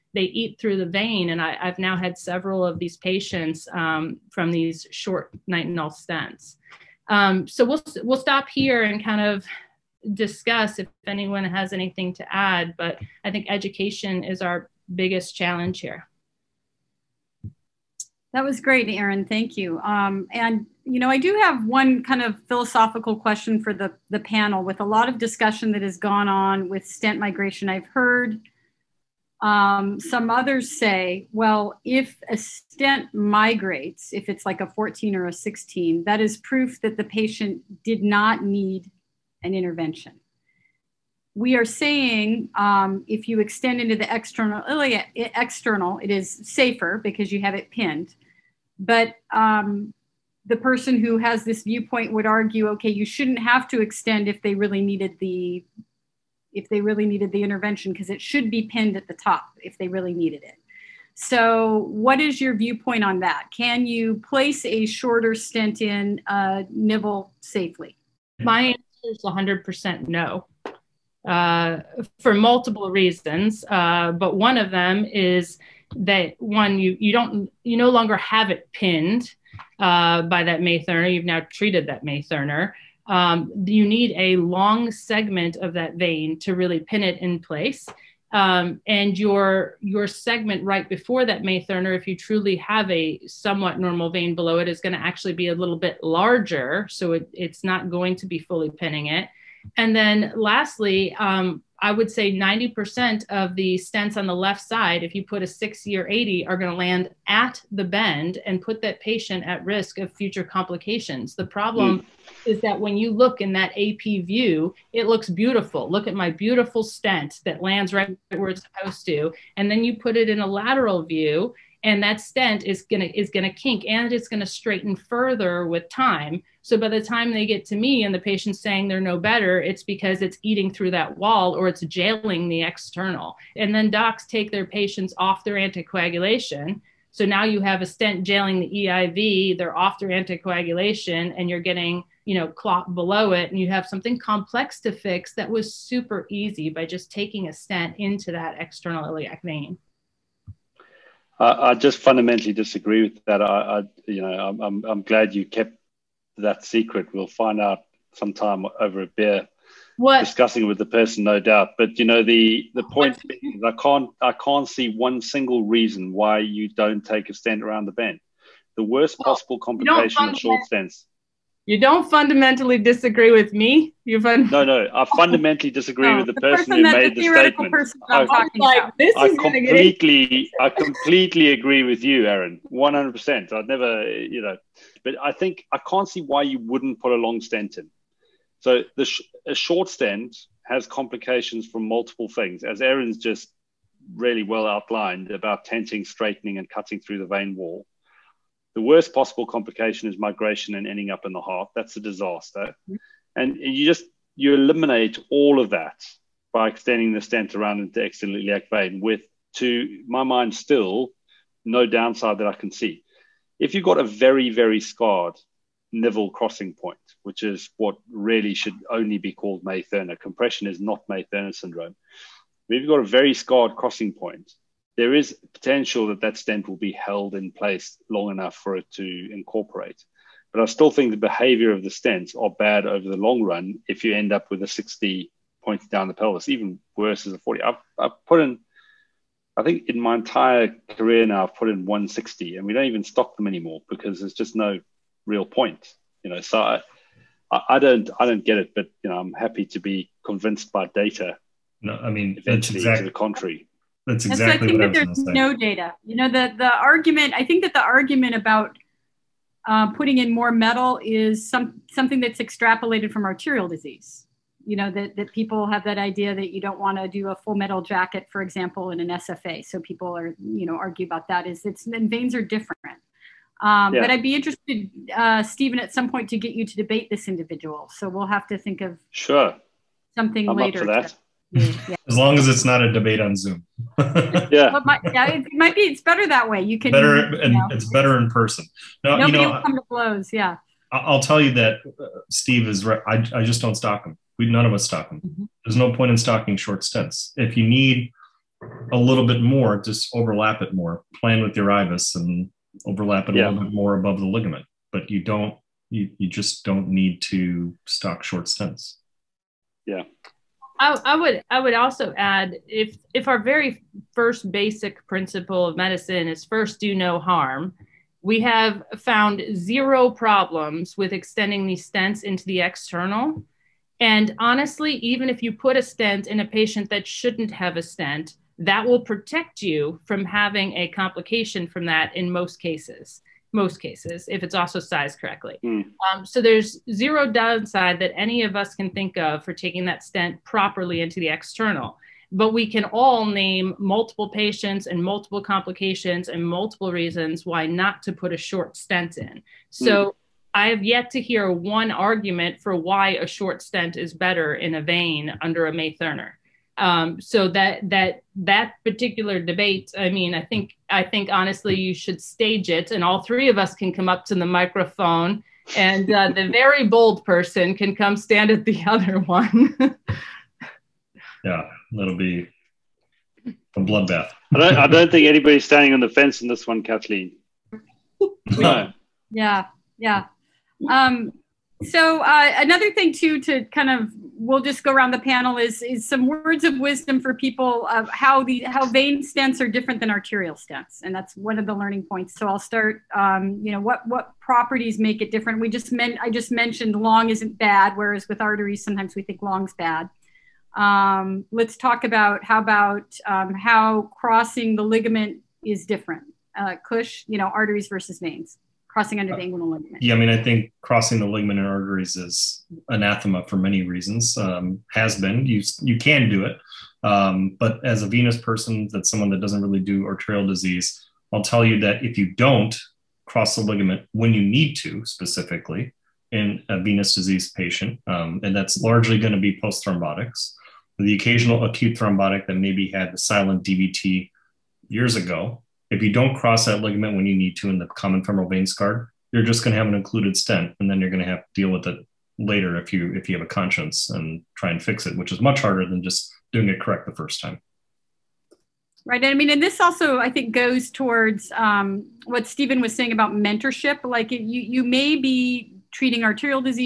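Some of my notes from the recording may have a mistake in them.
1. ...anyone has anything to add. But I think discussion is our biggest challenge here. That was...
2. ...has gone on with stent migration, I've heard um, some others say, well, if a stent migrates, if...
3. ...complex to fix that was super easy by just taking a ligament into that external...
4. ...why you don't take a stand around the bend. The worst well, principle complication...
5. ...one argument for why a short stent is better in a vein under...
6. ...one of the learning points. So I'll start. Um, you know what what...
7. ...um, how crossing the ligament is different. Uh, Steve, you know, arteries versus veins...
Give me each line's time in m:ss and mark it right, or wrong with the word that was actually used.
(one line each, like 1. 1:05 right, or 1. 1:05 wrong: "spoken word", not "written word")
1. 0:11 wrong: "education", not "discussion"
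2. 0:25 right
3. 2:24 wrong: "stent", not "ligament"
4. 2:46 wrong: "possible", not "principle"
5. 5:51 right
6. 6:31 right
7. 6:43 wrong: "Kush", not "Steve".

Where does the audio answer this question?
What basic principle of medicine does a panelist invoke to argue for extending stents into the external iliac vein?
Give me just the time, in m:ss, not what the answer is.
5:16.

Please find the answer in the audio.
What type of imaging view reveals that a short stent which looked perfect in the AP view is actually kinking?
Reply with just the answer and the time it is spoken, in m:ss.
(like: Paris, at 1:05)
lateral view, at 2:00.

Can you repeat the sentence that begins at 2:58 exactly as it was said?
I, like, I completely, I completely agree with you, Aaron, one hundred percent.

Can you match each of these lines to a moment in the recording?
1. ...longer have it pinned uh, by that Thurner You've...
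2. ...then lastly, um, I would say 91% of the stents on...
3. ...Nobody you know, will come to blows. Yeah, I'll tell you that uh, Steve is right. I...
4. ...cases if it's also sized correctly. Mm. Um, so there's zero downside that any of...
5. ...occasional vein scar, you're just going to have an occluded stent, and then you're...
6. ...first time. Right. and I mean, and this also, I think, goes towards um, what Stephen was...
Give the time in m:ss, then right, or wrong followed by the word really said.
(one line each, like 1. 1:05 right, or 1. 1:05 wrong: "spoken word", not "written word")
1. 1:17 wrong: "May", not "Thurner"
2. 1:39 wrong: "90", not "91"
3. 4:49 right
4. 5:33 right
5. 7:18 wrong: "femoral", not "occasional"
6. 7:27 right.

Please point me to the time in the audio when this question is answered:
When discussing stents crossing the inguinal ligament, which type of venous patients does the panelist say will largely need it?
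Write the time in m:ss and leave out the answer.
7:09.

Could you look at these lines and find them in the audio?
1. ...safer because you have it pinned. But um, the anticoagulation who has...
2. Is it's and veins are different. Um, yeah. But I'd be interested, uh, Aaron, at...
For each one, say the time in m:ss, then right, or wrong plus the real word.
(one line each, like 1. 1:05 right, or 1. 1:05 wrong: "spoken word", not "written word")
1. 0:46 wrong: "person", not "anticoagulation"
2. 4:31 wrong: "Stephen", not "Aaron".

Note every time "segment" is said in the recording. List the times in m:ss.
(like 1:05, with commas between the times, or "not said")
1:24, 1:30.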